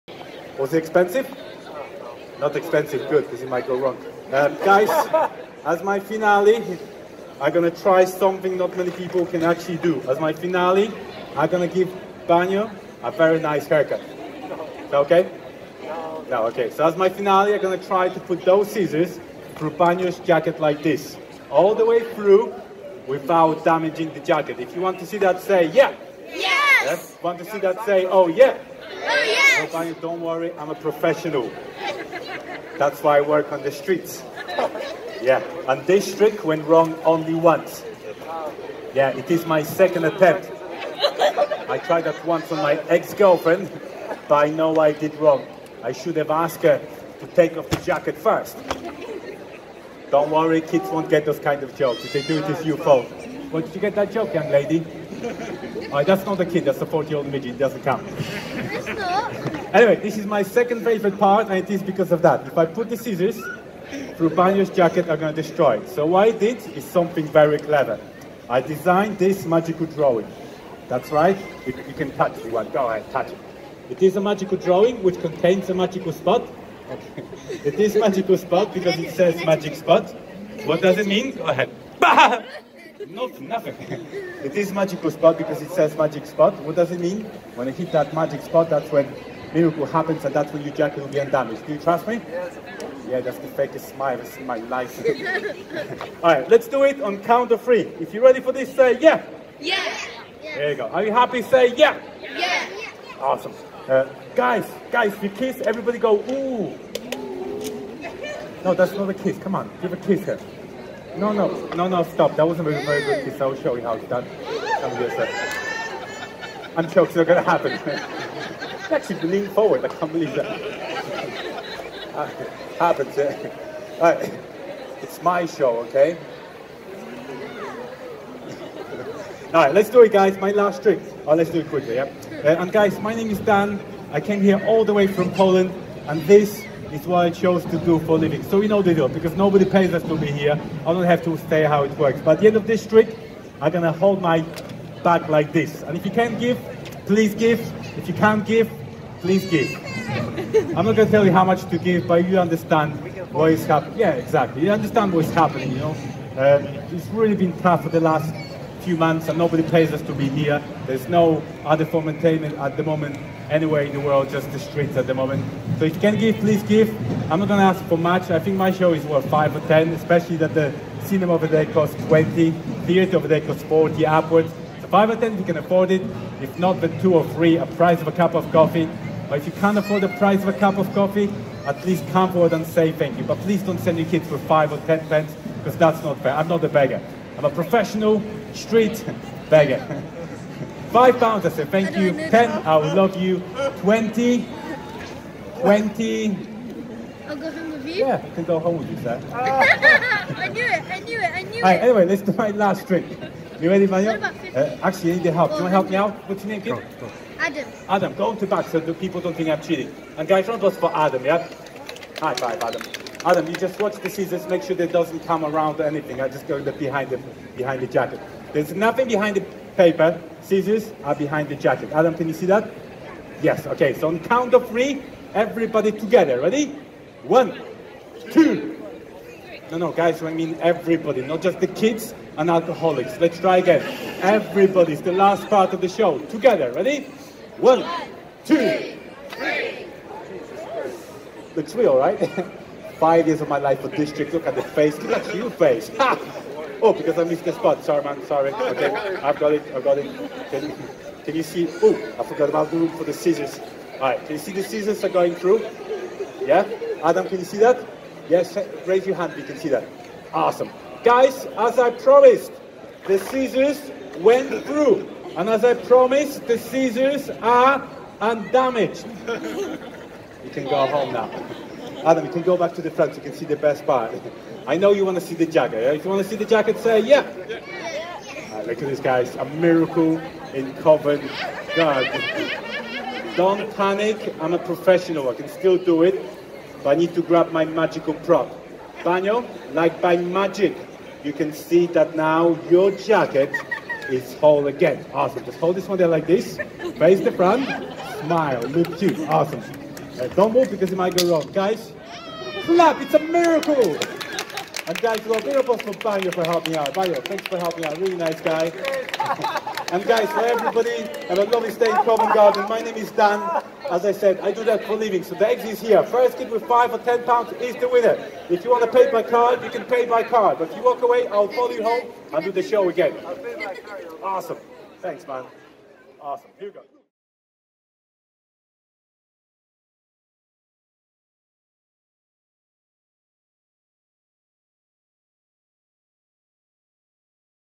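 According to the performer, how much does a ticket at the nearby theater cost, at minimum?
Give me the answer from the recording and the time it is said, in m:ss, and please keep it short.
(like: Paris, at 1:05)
40, at 2:53.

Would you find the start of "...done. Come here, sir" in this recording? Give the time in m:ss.
1:54.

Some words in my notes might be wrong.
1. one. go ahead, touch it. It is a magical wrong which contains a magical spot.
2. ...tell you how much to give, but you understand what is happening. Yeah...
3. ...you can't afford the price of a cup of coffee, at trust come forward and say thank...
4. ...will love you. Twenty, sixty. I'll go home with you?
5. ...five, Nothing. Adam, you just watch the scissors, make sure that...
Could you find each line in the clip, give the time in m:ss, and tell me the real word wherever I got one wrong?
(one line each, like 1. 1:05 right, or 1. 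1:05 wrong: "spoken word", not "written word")
1. 1:12 wrong: "drawing", not "wrong"
2. 2:31 right
3. 2:59 wrong: "least", not "trust"
4. 3:12 wrong: "twenty", not "sixty"
5. 3:32 wrong: "Adam", not "Nothing".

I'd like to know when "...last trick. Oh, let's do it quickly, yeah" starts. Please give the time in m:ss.
2:10.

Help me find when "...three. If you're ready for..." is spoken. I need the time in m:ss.
1:37.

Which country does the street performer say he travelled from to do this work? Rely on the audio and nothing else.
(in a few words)
Poland.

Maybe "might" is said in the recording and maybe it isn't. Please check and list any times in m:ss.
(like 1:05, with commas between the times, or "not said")
0:03, 5:00.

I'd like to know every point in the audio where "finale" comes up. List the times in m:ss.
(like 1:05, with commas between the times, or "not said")
0:05, 0:10, 0:17.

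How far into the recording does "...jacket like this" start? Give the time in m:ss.
0:20.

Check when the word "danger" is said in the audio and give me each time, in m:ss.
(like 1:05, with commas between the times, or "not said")
not said.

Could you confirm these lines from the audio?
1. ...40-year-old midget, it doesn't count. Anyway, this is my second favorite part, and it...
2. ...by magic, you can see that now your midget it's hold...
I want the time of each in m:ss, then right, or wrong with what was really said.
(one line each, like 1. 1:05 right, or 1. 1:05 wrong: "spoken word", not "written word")
1. 0:56 right
2. 4:50 wrong: "jacket", not "midget".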